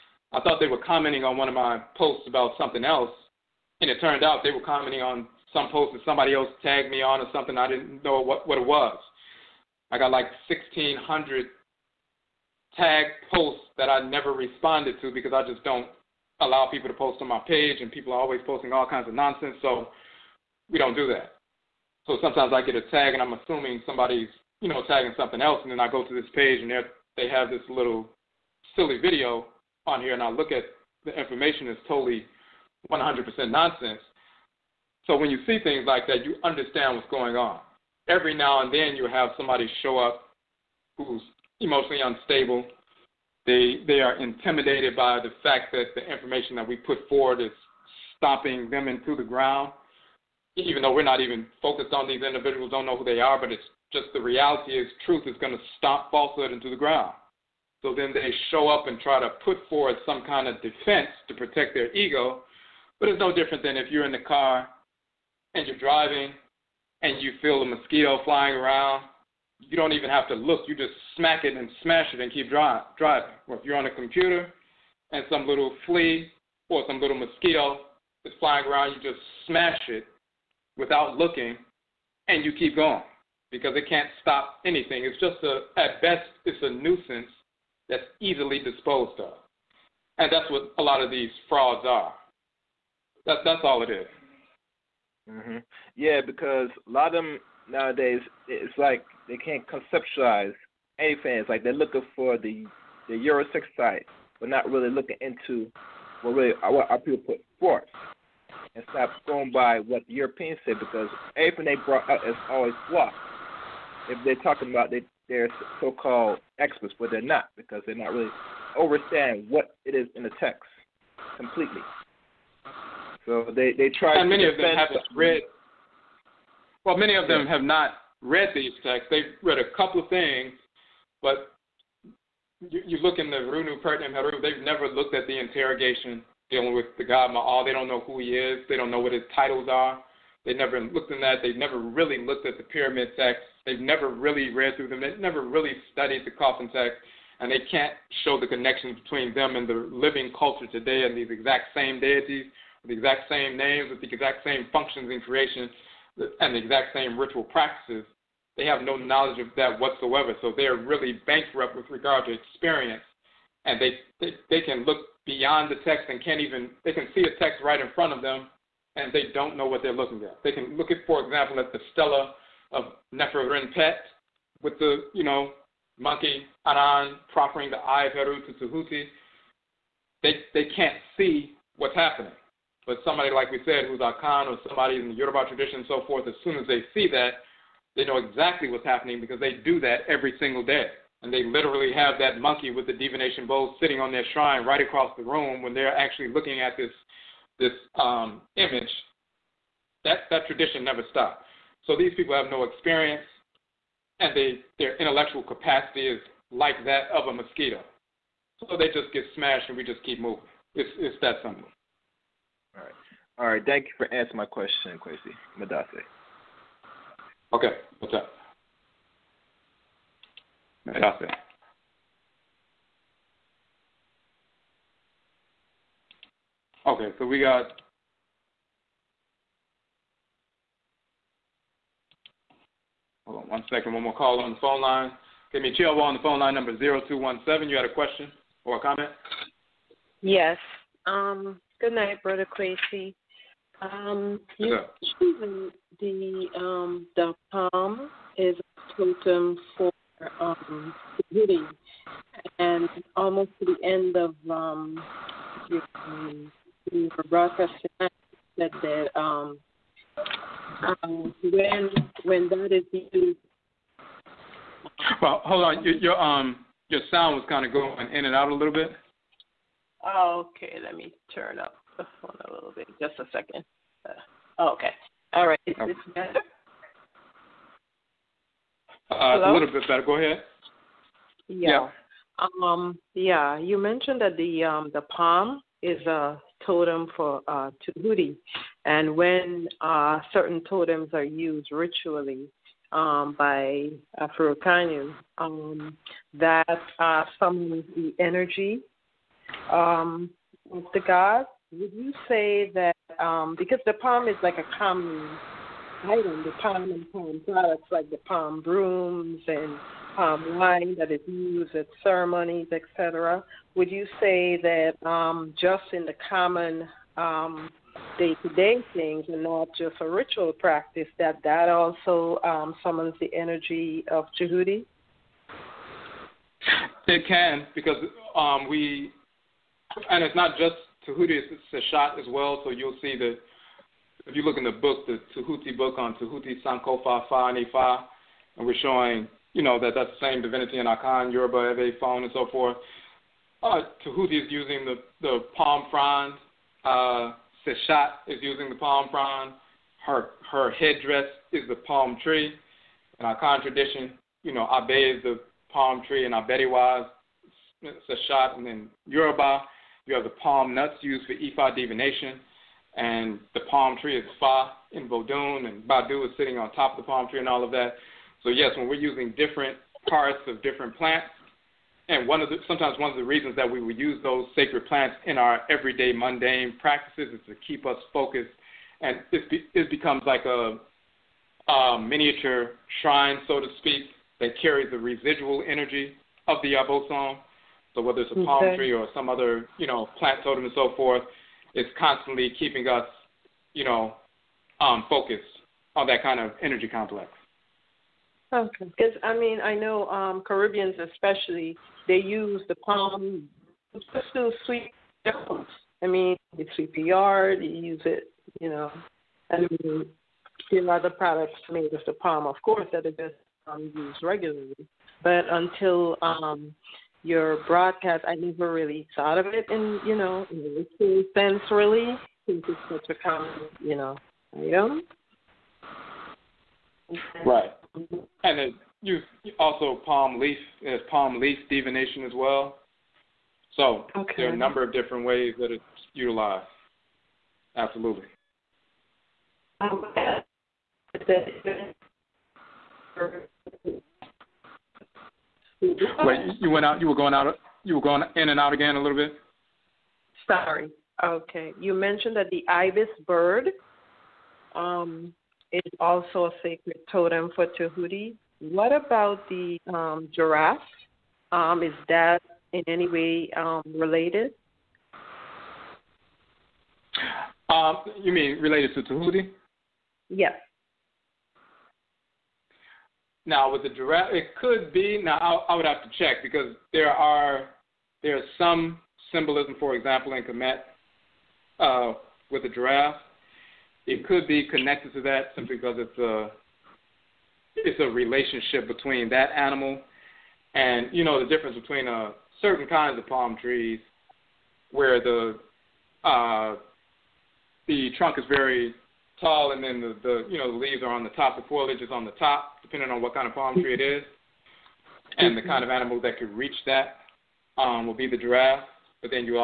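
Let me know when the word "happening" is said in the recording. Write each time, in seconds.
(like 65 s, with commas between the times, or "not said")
181 s, 188 s.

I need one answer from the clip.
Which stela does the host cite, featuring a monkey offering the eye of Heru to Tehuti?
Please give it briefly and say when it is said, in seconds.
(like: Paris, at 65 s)
Stela of Neferenpet, at 171 s.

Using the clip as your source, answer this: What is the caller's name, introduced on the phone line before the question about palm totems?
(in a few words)
Chilwell.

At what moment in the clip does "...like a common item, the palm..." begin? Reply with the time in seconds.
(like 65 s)
304 s.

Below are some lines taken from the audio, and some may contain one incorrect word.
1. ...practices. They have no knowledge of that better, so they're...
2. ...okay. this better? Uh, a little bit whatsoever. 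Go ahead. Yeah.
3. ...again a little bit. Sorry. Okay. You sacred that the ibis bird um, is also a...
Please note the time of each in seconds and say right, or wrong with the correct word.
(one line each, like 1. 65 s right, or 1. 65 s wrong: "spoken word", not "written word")
1. 157 s wrong: "whatsoever", not "better"
2. 275 s wrong: "better", not "whatsoever"
3. 448 s wrong: "mentioned", not "sacred".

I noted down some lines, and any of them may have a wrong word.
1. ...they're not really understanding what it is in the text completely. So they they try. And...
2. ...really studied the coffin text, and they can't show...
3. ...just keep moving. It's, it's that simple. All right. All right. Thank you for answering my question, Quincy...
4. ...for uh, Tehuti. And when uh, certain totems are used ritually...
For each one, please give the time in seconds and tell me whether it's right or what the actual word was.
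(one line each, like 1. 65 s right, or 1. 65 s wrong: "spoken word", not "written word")
1. 117 s right
2. 145 s right
3. 209 s right
4. 287 s right.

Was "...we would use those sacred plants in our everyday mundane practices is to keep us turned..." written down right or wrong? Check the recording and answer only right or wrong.
wrong.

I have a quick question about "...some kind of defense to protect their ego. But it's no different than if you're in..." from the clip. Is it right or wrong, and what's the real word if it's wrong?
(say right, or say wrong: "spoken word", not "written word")
right.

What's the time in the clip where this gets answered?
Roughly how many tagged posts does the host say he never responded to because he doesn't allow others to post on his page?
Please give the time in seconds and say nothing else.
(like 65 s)
10 s.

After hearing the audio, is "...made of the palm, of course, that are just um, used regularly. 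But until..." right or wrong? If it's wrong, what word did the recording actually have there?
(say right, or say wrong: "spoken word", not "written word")
right.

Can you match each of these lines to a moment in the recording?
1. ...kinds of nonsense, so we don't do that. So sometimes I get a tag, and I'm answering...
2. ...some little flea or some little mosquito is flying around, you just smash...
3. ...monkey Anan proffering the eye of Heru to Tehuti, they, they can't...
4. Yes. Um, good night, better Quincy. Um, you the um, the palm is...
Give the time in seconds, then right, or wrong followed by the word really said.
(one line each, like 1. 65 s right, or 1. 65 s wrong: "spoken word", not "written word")
1. 18 s wrong: "assuming", not "answering"
2. 75 s right
3. 175 s right
4. 240 s wrong: "brother", not "better".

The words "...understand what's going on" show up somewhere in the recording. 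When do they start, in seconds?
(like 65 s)
36 s.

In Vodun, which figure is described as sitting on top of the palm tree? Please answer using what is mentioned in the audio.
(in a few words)
Gbadu.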